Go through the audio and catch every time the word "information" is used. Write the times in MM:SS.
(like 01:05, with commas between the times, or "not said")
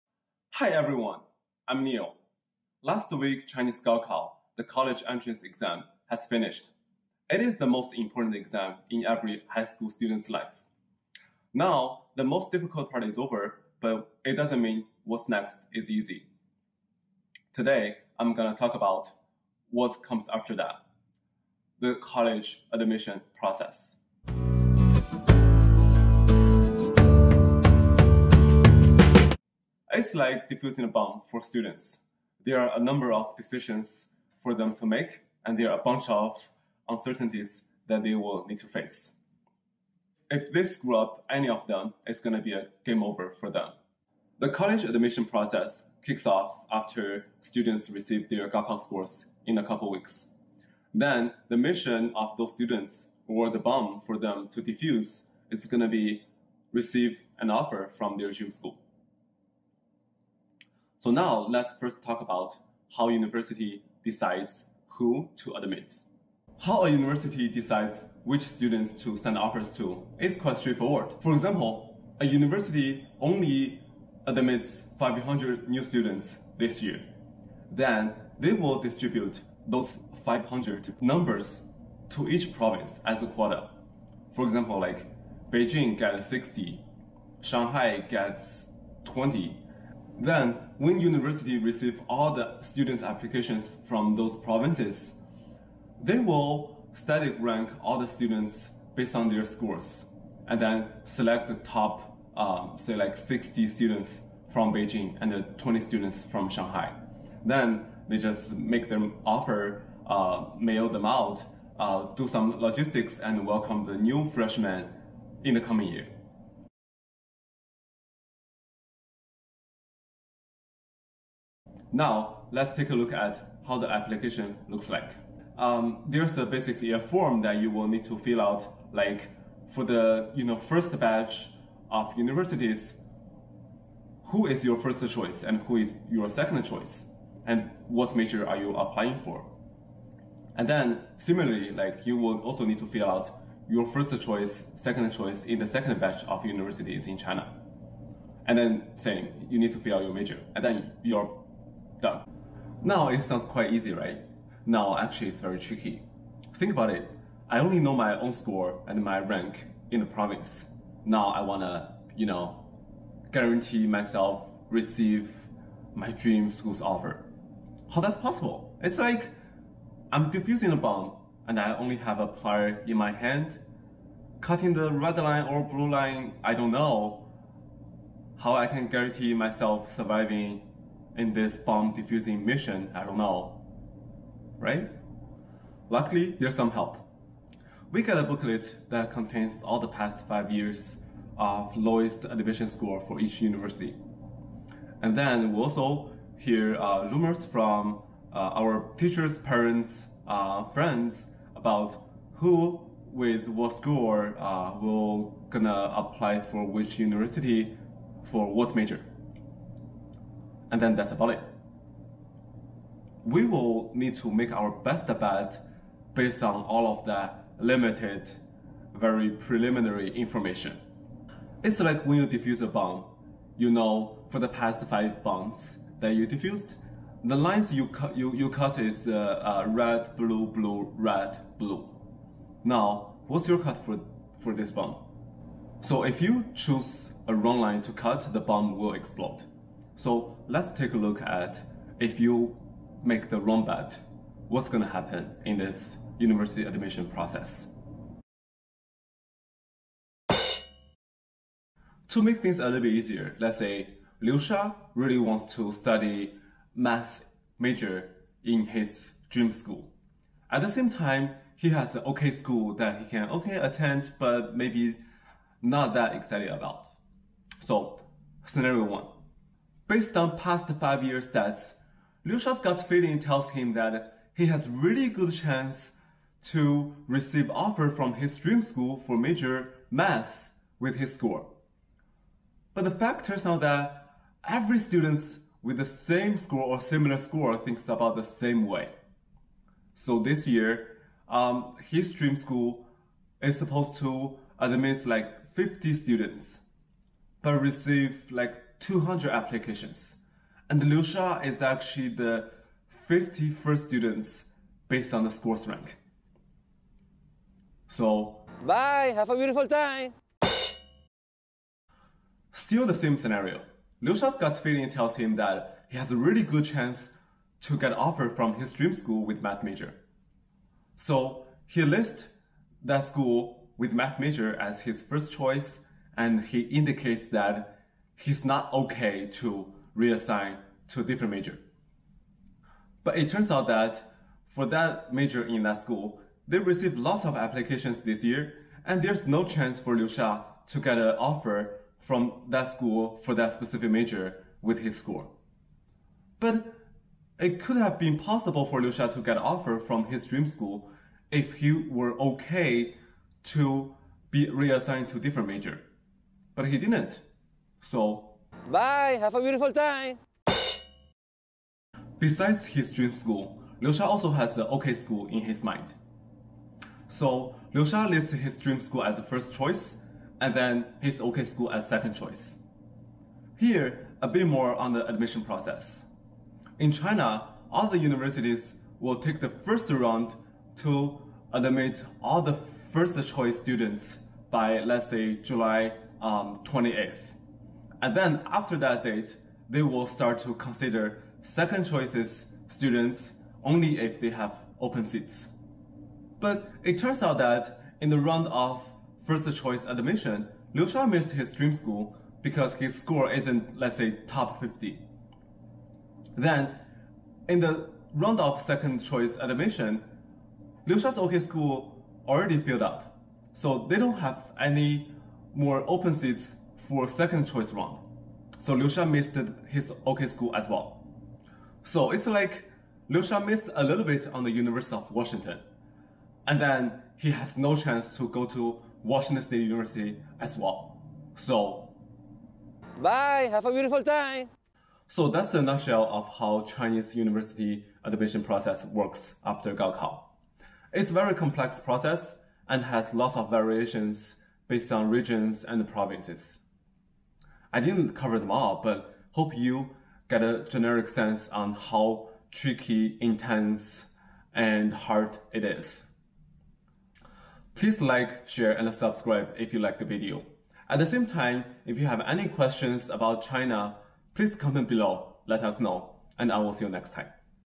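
03:40.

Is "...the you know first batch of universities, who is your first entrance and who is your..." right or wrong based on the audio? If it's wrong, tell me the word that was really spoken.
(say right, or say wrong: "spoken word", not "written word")
wrong: "choice", not "entrance".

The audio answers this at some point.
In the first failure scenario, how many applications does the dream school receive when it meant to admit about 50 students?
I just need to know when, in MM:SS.
04:58.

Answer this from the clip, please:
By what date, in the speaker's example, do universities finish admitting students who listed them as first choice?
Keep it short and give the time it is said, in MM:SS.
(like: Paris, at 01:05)
July 28th, at 06:25.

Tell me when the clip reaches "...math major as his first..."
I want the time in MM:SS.
05:23.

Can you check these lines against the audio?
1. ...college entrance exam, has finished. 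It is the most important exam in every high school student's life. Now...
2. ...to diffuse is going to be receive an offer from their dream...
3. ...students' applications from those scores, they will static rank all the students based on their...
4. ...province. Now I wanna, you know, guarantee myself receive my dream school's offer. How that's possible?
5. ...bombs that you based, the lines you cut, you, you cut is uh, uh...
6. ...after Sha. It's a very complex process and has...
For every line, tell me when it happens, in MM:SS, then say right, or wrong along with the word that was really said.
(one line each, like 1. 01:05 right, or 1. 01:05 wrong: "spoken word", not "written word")
1. 00:04 right
2. 00:54 right
3. 01:32 wrong: "provinces", not "scores"
4. 02:40 right
5. 03:45 wrong: "defused", not "based"
6. 07:19 wrong: "Gaokao", not "Sha".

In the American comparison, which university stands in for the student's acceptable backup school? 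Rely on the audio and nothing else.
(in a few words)
Washington State University.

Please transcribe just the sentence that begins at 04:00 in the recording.
So let's take a look at if you make the wrong bet, what's going to happen in this university admission process.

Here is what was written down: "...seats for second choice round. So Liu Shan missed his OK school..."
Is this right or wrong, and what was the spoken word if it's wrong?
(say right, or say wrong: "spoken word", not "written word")
right.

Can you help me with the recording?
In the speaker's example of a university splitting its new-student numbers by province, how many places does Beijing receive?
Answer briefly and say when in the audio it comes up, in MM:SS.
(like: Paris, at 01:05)
60, at 01:25.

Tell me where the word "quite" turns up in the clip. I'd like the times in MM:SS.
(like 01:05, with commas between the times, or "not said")
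01:10, 02:33.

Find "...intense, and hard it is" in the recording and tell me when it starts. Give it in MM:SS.
07:33.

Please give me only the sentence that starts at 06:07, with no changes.
So, Liu Sha lists his dream school as the first choice, and then his OK school as second choice.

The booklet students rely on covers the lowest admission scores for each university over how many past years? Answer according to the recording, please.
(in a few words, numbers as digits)
5 years.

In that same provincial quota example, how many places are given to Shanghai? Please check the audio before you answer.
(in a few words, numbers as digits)
20.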